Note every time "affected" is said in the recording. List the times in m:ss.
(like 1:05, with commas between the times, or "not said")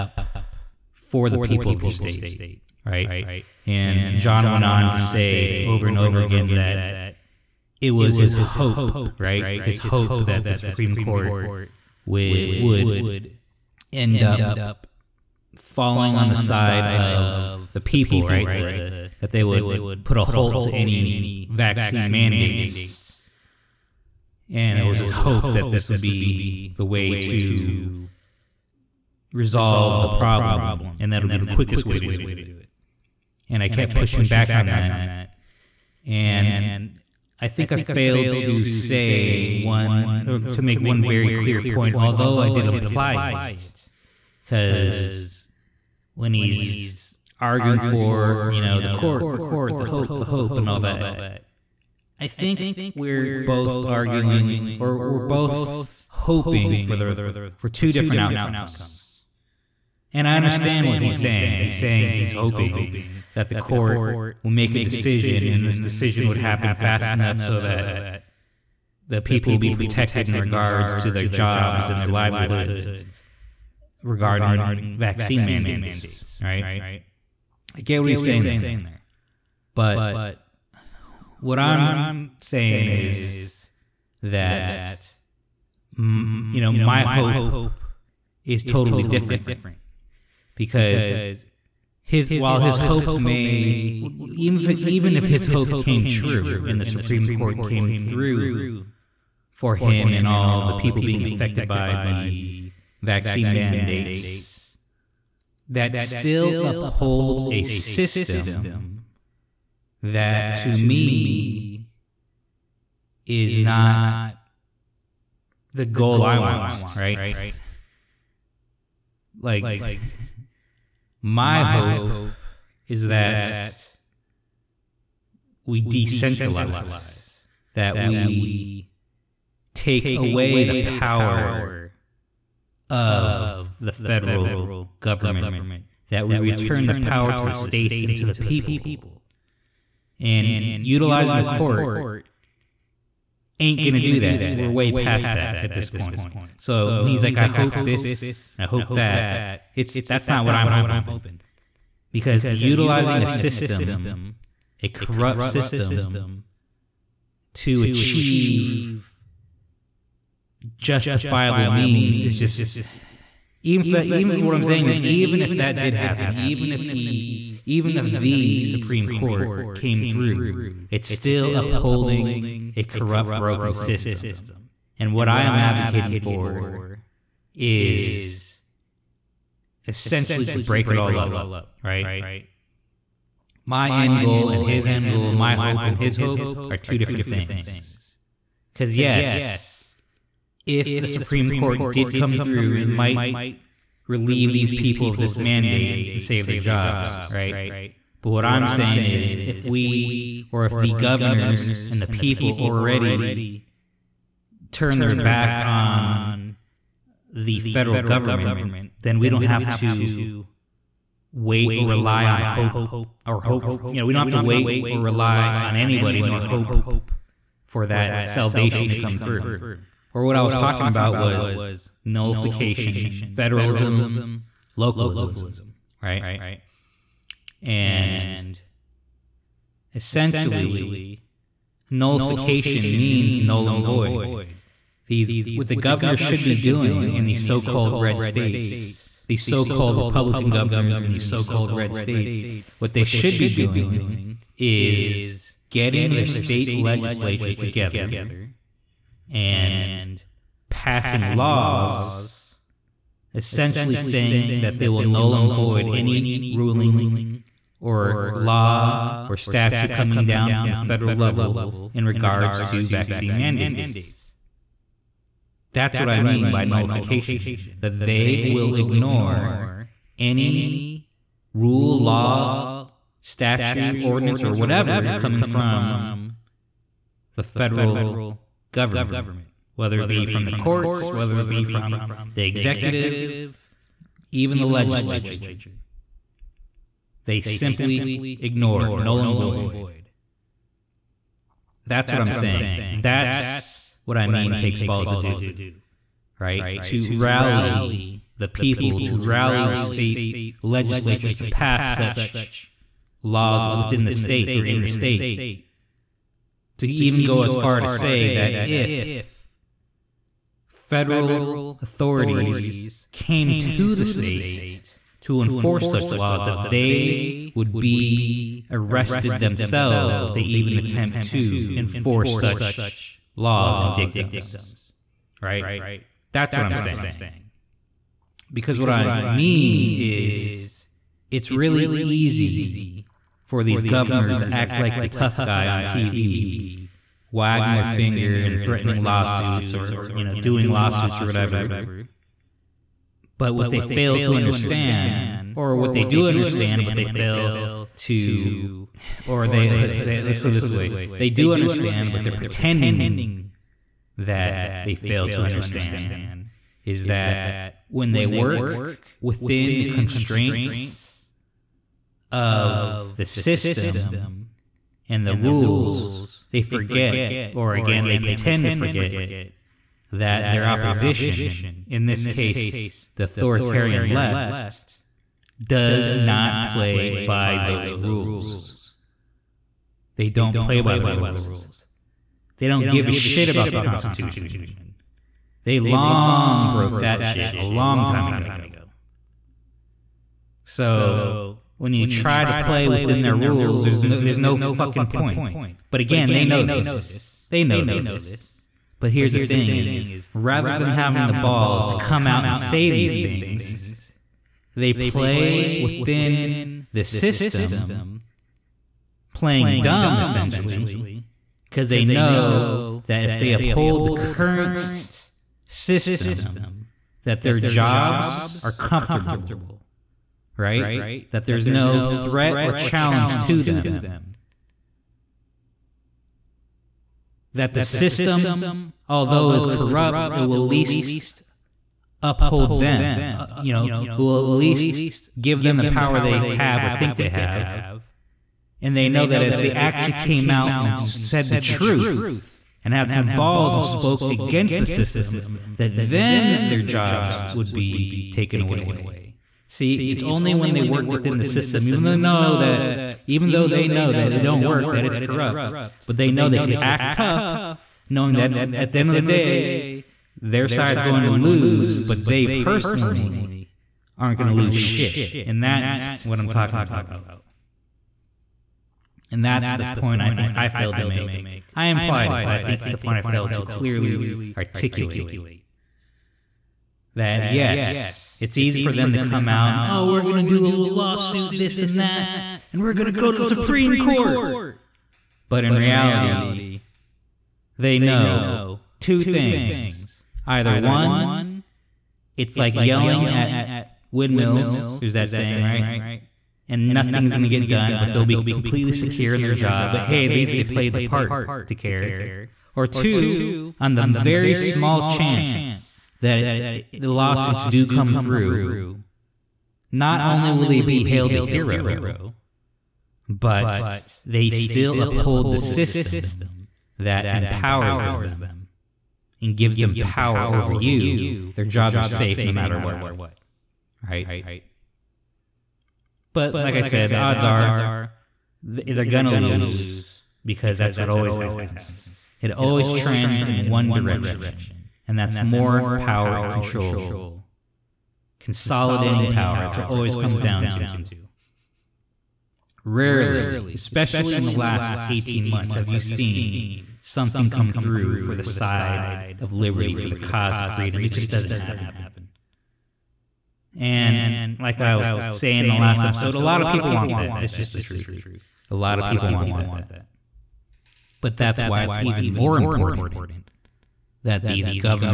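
1:41.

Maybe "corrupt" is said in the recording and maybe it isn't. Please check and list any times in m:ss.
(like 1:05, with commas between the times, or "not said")
2:34, 2:52, 7:09, 7:35.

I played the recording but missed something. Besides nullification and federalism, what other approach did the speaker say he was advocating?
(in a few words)
Localism.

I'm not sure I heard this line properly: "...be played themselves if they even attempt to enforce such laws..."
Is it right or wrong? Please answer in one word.
wrong.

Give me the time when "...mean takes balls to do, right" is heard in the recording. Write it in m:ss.
4:54.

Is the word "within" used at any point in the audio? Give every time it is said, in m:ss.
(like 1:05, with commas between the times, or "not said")
5:03, 5:59, 6:32, 6:45, 7:31.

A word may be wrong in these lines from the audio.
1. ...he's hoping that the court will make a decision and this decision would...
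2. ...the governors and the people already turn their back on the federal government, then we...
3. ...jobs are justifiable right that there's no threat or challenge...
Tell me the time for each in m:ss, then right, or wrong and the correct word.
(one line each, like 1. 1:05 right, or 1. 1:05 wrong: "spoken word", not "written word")
1. 1:02 right
2. 3:20 right
3. 6:57 wrong: "comfortable", not "justifiable".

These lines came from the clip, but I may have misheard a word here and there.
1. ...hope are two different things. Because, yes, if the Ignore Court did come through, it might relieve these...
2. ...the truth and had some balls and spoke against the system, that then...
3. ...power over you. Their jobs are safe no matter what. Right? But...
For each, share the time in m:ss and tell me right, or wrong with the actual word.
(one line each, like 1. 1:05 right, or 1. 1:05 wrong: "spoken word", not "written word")
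1. 3:06 wrong: "Supreme", not "Ignore"
2. 7:21 right
3. 8:39 right.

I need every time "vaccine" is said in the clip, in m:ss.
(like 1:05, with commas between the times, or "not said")
0:21, 1:14, 1:43, 4:22.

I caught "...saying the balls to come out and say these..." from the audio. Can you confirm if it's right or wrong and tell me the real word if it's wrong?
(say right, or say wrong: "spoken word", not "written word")
wrong: "having", not "saying".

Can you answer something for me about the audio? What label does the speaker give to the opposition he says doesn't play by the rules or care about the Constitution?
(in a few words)
authoritarian left.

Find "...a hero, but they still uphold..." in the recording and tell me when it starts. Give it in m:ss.
8:31.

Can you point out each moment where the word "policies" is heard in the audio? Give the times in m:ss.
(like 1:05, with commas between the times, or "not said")
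not said.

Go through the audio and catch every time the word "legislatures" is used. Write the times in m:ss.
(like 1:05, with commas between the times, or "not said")
4:06, 4:44, 5:00.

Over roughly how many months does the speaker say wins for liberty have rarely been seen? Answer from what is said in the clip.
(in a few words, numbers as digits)
18.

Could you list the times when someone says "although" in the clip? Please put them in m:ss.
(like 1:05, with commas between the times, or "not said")
0:41, 7:09.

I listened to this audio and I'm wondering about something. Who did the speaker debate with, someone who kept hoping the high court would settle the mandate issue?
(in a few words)
John.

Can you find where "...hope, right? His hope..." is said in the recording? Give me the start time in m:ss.
0:08.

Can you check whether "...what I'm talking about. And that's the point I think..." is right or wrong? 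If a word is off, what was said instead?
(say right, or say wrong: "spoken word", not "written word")
right.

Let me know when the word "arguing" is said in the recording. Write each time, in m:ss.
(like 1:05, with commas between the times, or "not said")
0:47, 0:53.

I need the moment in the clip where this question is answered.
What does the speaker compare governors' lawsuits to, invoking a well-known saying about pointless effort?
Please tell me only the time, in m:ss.
8:12.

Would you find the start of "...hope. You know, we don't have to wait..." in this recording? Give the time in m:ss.
3:33.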